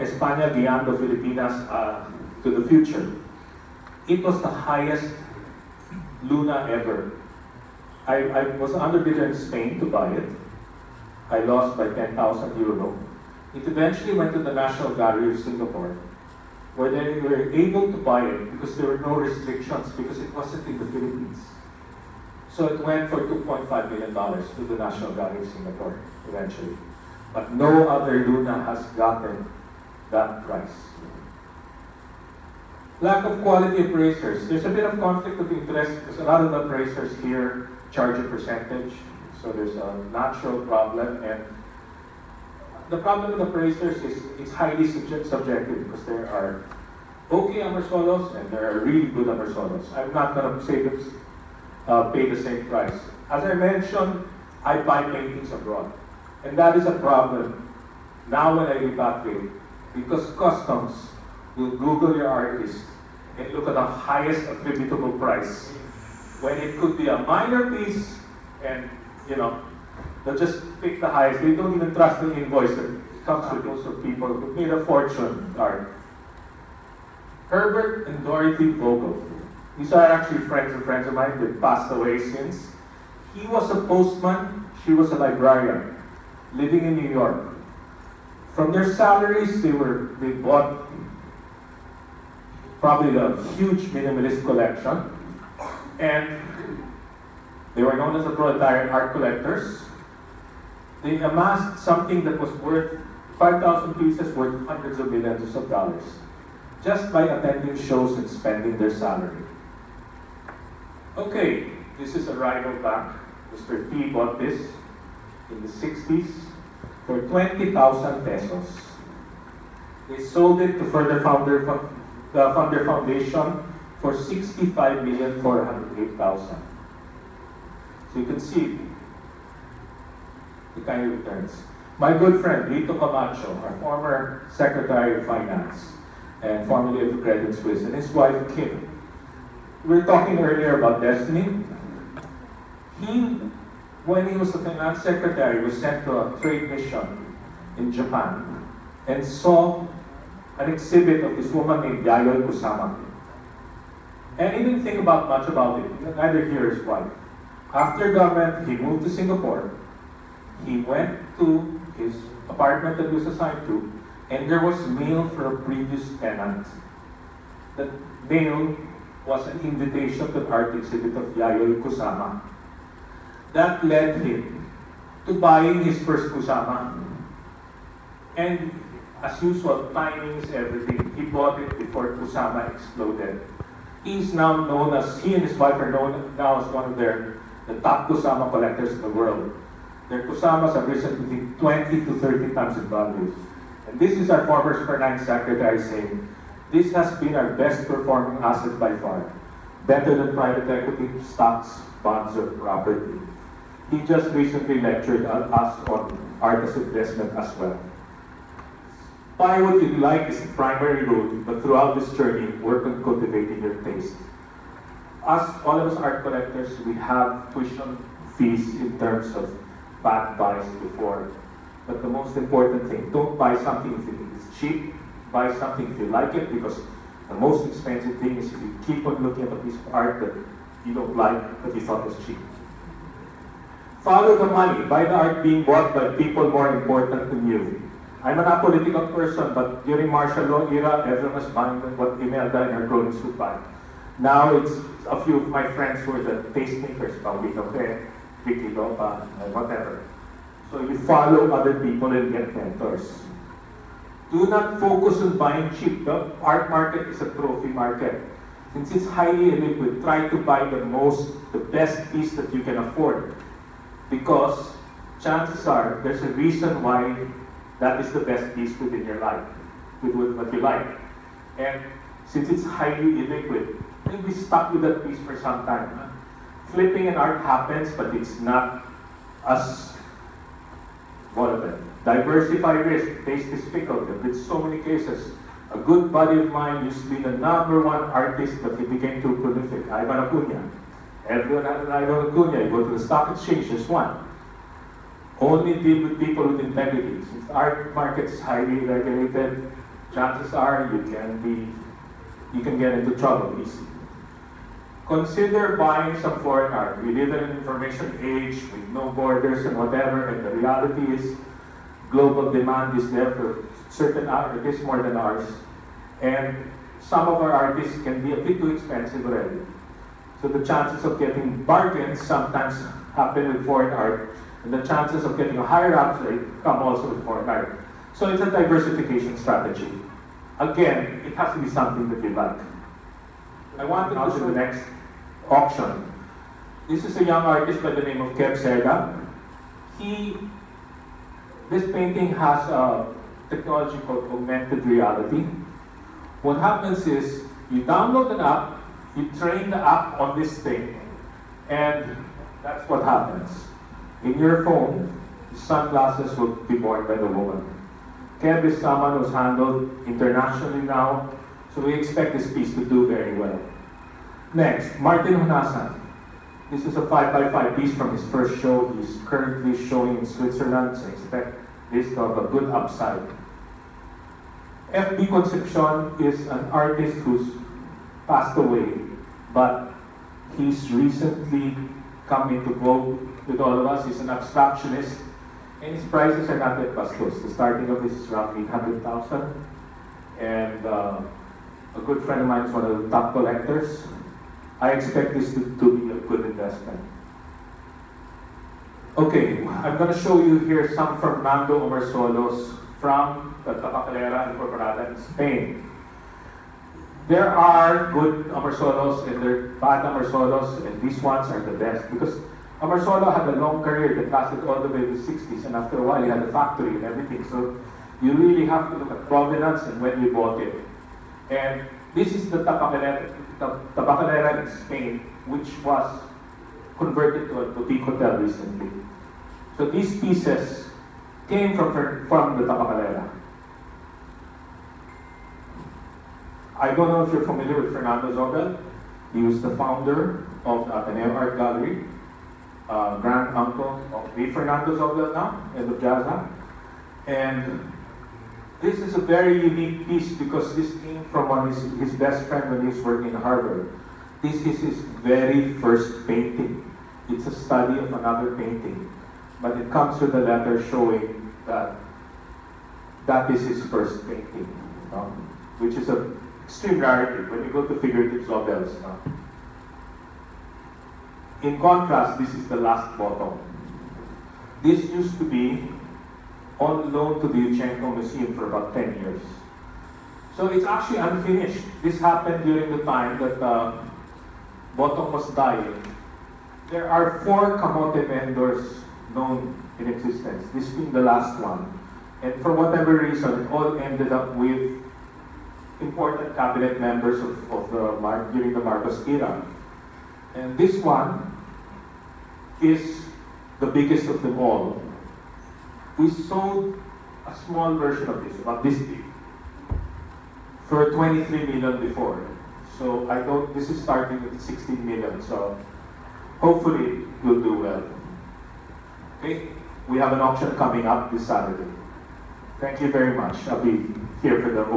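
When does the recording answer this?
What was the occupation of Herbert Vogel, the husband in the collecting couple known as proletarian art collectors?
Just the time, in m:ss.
1:23.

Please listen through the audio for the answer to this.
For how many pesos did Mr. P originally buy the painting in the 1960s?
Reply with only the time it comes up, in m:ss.
1:57.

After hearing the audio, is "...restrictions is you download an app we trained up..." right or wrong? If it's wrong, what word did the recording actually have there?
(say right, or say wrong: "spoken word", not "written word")
wrong: "happens", not "restrictions".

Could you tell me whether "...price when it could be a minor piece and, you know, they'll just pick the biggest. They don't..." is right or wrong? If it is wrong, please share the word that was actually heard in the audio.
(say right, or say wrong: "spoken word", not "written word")
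wrong: "highest", not "biggest".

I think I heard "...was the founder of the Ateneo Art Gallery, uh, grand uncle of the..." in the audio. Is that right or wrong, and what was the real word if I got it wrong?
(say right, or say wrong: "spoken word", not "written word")
right.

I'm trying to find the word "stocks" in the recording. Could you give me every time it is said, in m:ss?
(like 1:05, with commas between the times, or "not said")
3:21, 4:53.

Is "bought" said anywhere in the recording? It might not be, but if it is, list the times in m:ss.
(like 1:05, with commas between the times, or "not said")
1:30, 1:54, 3:01, 3:55, 7:00.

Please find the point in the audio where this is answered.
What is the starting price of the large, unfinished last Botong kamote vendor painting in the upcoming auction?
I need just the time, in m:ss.
8:34.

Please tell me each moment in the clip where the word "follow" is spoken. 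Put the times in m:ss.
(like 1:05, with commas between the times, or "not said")
3:54, 4:10.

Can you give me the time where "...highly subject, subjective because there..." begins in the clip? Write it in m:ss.
0:44.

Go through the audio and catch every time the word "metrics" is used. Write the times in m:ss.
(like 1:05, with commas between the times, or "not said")
not said.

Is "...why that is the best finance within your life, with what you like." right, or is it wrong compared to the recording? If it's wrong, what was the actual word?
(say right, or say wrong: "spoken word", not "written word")
wrong: "piece", not "finance".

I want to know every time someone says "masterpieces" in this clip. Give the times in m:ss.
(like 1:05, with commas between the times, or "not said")
not said.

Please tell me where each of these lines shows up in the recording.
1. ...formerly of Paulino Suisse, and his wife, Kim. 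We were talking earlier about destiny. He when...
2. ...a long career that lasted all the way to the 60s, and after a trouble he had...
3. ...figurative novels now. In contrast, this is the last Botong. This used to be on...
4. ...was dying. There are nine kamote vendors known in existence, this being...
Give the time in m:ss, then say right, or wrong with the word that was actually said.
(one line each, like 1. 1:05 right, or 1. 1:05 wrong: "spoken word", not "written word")
1. 2:16 wrong: "Credit", not "Paulino"
2. 6:53 wrong: "while", not "trouble"
3. 7:48 right
4. 8:05 wrong: "four", not "nine".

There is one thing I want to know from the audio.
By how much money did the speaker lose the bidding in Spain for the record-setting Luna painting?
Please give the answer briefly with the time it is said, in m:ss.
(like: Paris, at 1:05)
10,000 euro, at 0:11.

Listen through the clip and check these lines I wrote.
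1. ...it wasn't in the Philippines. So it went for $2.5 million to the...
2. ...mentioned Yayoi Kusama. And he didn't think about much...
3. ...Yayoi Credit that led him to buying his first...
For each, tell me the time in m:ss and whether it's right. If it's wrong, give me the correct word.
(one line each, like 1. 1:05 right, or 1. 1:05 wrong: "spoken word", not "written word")
1. 0:20 right
2. 2:31 wrong: "named", not "mentioned"
3. 2:51 wrong: "Kusama", not "Credit".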